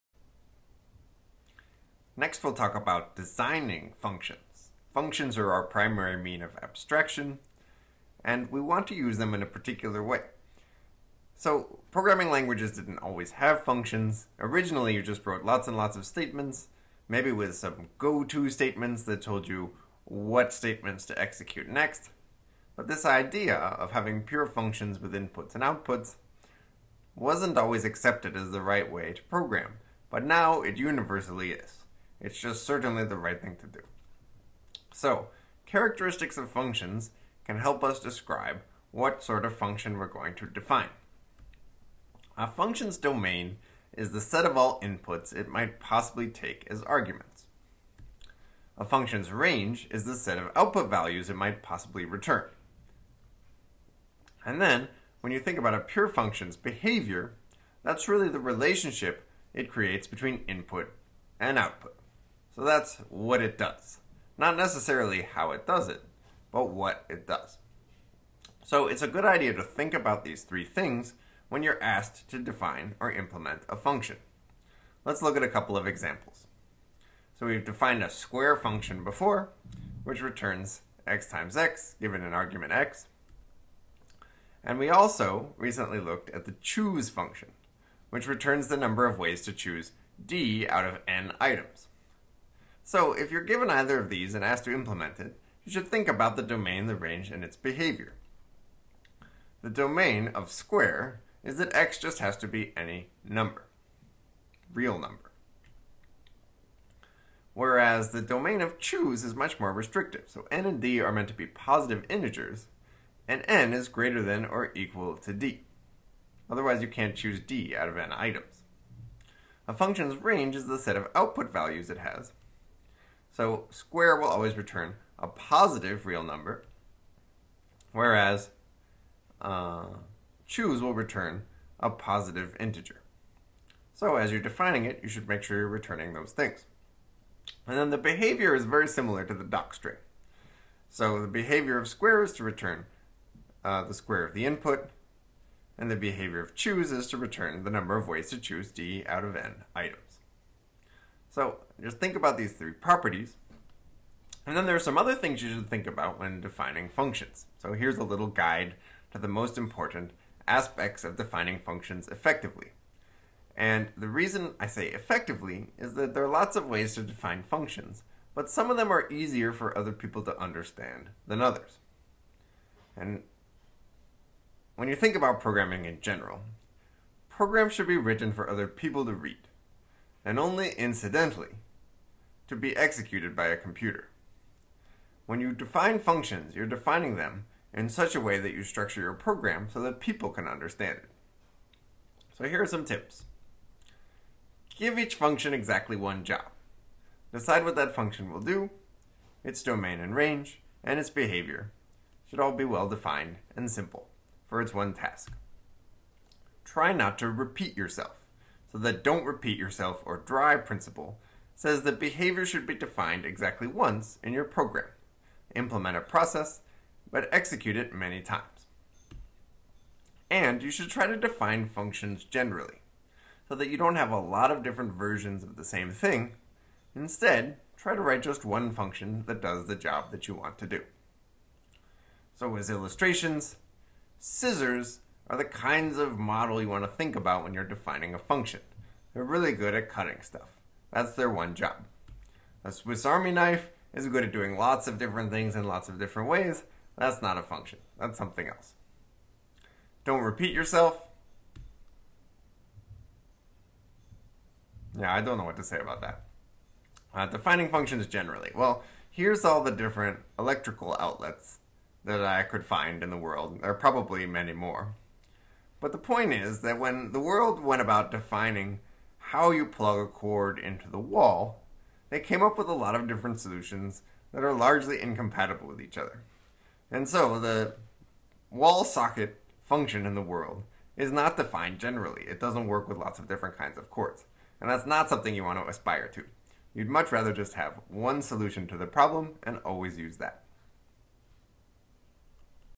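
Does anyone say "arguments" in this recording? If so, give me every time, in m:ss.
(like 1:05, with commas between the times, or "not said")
0:46, 1:22.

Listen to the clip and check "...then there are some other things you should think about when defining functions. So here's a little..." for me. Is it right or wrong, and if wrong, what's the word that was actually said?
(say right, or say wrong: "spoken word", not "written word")
right.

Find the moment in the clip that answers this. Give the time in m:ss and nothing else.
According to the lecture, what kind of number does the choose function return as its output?
2:11.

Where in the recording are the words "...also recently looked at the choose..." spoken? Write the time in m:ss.
1:24.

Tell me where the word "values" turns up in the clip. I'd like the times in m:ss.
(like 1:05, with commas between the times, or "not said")
0:50, 2:01.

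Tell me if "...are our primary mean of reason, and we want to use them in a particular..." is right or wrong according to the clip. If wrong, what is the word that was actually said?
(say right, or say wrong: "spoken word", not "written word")
wrong: "abstraction", not "reason".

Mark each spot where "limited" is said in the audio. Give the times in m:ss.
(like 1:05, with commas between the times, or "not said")
not said.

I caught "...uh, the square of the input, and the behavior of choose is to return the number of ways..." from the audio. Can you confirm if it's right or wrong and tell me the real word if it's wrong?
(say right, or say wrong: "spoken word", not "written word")
right.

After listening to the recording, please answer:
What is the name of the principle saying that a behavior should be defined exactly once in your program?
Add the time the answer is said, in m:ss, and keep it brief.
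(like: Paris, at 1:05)
DRY principle, at 3:30.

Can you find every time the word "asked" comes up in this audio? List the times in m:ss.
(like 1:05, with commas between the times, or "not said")
1:11, 1:34.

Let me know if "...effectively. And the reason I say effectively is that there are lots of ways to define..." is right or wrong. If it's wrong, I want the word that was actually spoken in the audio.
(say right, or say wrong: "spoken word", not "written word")
right.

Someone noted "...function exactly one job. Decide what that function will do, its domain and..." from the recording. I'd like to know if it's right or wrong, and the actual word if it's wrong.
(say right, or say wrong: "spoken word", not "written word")
right.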